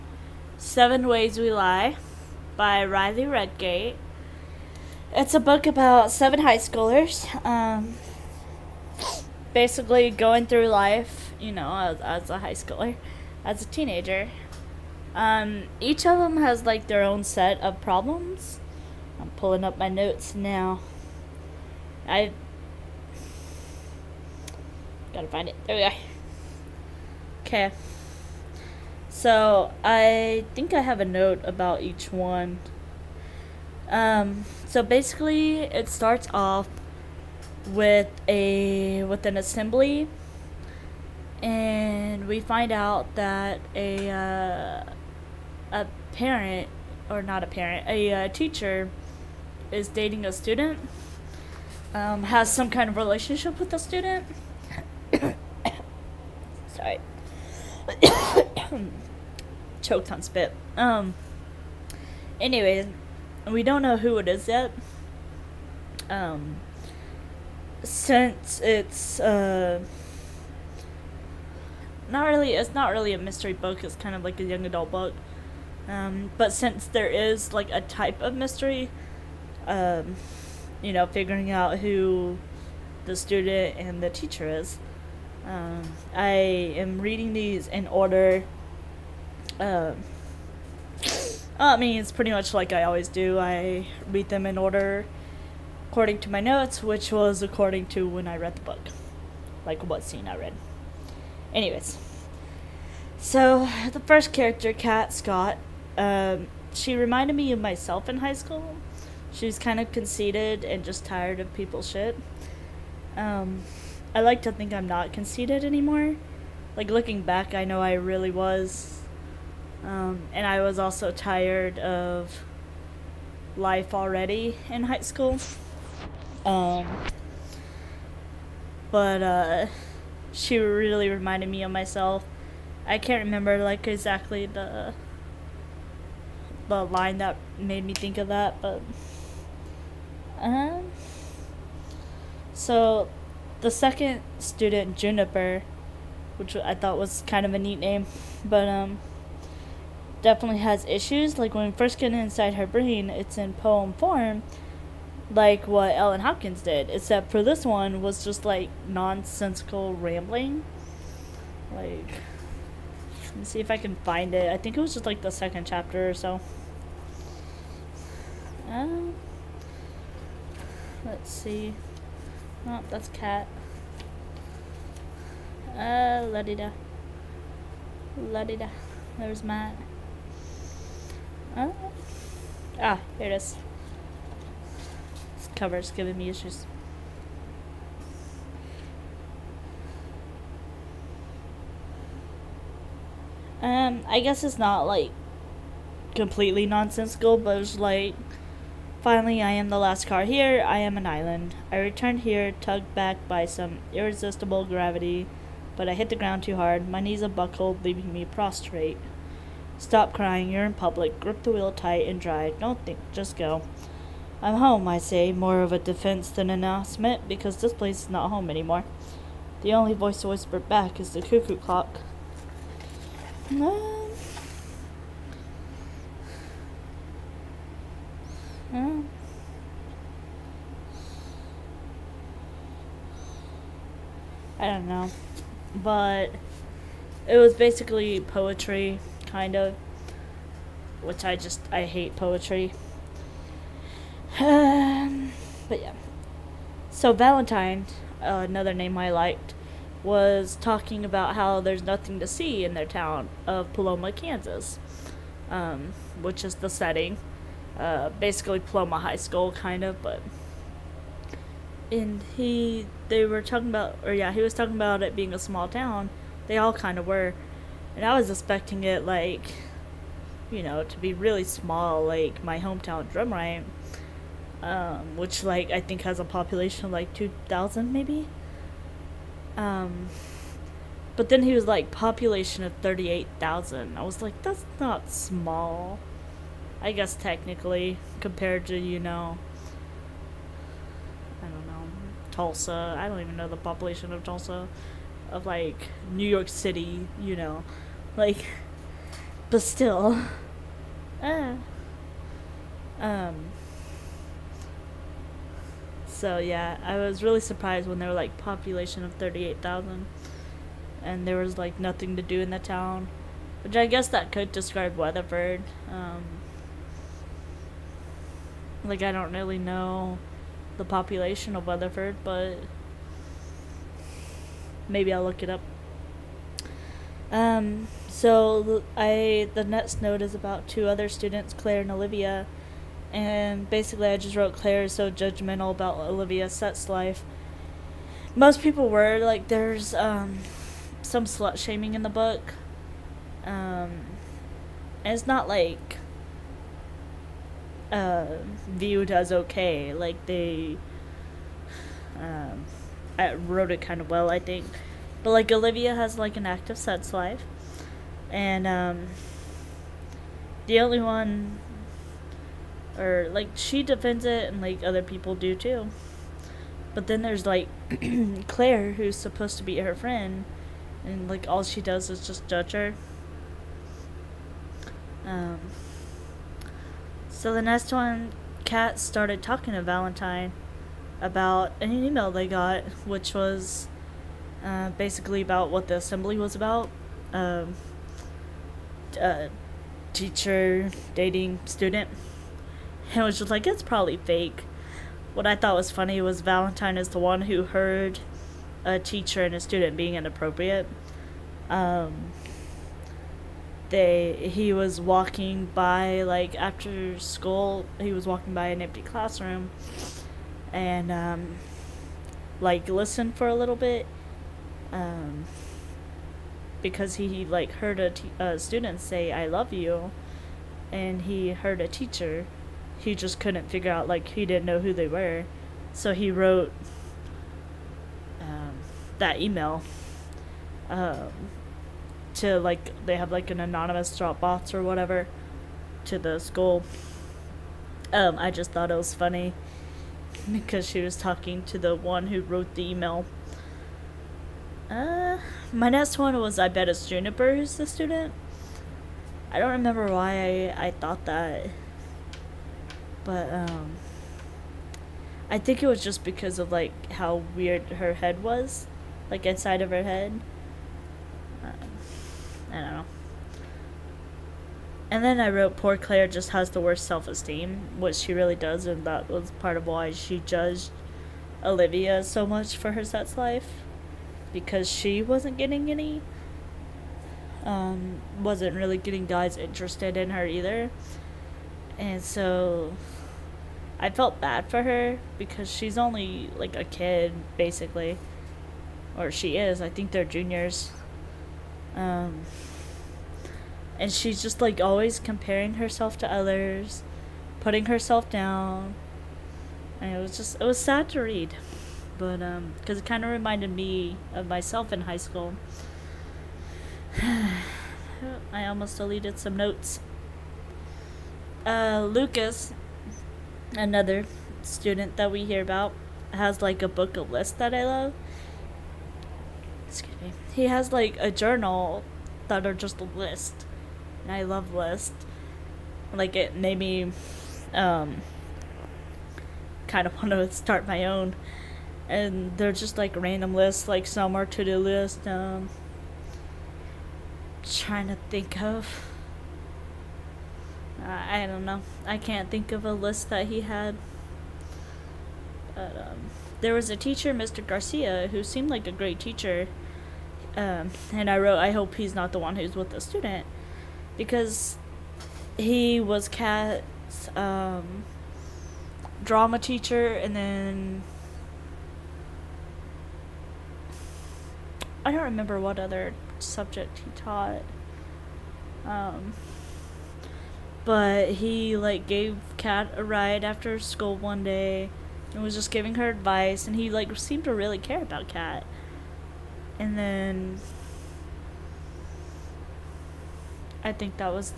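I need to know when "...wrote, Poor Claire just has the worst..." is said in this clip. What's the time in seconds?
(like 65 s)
465 s.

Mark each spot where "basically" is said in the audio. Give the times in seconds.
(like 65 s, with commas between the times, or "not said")
9 s, 34 s, 237 s, 258 s, 333 s, 384 s, 487 s.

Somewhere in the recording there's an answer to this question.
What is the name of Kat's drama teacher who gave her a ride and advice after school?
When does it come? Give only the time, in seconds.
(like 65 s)
547 s.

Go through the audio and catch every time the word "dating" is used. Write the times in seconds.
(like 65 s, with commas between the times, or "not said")
49 s, 391 s.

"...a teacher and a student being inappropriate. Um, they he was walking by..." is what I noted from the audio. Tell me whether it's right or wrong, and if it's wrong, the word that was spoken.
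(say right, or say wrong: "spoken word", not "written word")
right.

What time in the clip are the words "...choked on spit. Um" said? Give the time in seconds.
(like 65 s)
59 s.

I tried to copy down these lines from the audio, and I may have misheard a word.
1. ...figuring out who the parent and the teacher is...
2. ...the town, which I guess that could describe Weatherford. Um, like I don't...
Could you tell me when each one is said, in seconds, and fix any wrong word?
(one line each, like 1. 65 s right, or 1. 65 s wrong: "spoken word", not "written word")
1. 81 s wrong: "student", not "parent"
2. 312 s right.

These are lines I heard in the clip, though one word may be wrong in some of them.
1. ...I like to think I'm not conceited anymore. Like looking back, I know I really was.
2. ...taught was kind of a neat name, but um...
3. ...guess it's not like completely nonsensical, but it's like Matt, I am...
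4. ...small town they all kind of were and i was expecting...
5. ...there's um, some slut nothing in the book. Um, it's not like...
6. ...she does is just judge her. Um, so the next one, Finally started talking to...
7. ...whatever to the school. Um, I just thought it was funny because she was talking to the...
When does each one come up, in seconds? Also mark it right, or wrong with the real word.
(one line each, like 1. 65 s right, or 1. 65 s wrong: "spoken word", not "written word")
1. 114 s right
2. 146 s wrong: "thought", not "taught"
3. 194 s wrong: "Finally", not "Matt"
4. 265 s right
5. 339 s wrong: "shaming", not "nothing"
6. 371 s wrong: "Kat", not "Finally"
7. 434 s right.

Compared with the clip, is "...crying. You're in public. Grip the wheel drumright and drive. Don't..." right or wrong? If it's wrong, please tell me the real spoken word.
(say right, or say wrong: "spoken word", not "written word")
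wrong: "tight", not "drumright".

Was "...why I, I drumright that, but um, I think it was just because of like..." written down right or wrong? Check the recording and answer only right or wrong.
wrong.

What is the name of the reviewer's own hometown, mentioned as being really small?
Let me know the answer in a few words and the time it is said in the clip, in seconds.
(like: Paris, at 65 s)
Drumright, at 273 s.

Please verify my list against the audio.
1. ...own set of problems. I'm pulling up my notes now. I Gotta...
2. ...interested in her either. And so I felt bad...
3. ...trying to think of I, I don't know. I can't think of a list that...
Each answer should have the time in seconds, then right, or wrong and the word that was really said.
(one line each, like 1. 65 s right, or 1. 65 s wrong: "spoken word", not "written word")
1. 17 s right
2. 479 s right
3. 537 s right.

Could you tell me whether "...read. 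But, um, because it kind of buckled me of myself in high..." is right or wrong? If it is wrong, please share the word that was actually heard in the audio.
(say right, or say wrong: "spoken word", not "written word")
wrong: "reminded", not "buckled".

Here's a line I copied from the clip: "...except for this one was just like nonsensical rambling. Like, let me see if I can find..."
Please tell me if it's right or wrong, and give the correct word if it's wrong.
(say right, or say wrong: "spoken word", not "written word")
right.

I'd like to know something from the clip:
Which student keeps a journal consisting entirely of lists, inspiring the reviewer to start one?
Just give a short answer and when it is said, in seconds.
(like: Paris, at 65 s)
Lucas, at 512 s.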